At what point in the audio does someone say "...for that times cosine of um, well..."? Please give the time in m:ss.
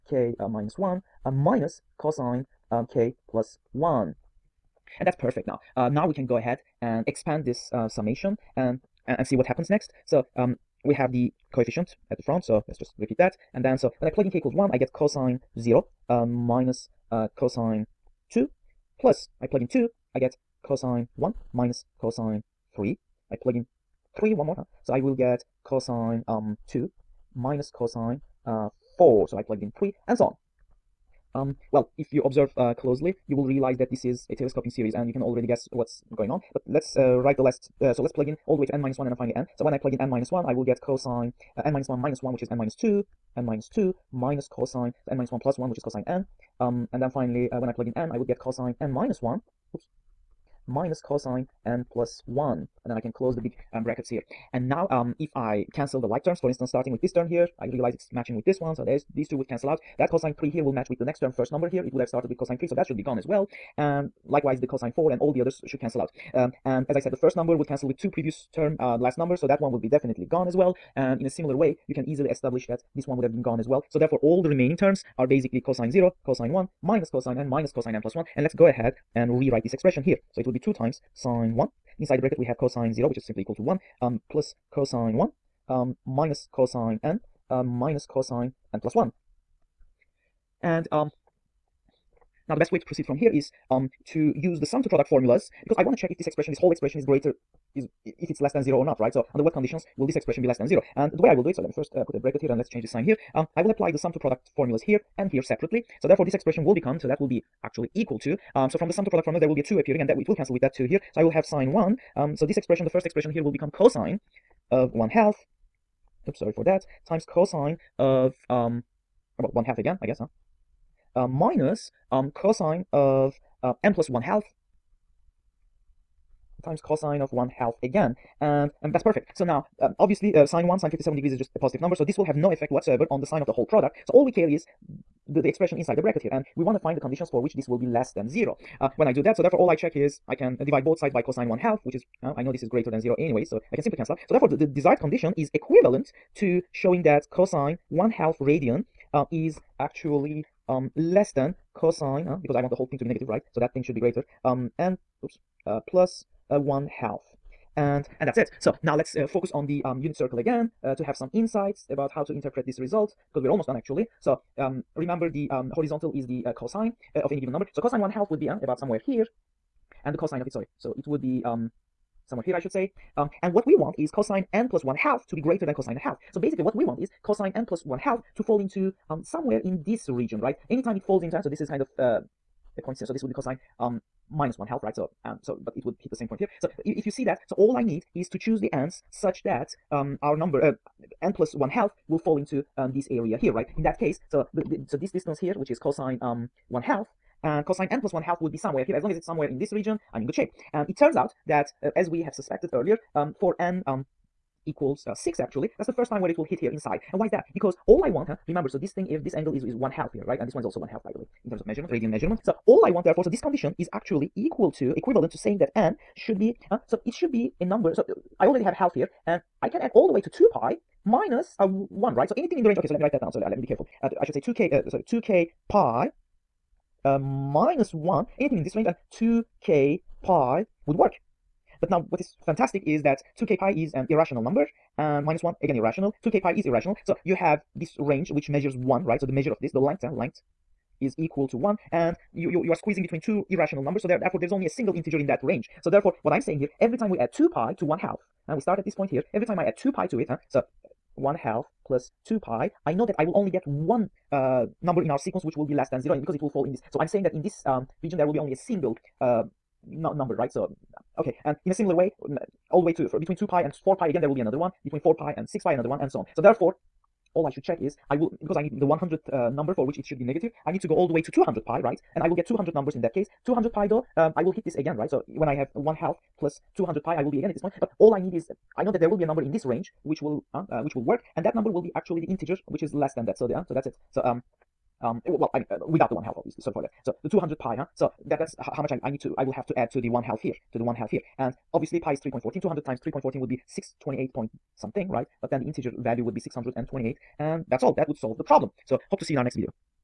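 1:56.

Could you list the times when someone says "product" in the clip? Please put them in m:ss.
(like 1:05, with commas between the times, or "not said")
1:34, 1:44, 1:49, 2:13.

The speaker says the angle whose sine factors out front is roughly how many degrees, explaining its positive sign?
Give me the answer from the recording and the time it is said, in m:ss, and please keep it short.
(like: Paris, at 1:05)
57 degrees, at 2:10.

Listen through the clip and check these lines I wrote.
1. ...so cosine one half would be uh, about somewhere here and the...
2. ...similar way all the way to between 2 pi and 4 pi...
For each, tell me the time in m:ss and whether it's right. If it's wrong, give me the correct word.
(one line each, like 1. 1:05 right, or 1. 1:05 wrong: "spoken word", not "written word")
1. 2:47 right
2. 4:21 right.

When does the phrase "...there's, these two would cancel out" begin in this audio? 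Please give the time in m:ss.
0:58.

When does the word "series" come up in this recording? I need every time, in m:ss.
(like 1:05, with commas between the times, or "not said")
0:34.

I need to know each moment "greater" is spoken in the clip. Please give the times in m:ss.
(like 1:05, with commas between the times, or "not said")
1:37, 2:22, 2:33, 2:55.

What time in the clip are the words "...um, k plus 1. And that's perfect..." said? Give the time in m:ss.
0:02.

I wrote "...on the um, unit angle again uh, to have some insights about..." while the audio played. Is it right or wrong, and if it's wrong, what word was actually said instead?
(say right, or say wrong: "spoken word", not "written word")
wrong: "circle", not "angle".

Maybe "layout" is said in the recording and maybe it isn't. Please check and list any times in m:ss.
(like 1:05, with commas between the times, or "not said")
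not said.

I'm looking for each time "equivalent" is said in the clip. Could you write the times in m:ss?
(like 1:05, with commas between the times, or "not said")
2:25, 3:35.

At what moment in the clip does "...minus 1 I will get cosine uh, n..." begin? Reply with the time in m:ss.
0:40.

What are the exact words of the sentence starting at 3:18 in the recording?
As long as it's somewhere in this region, I'm in good shape.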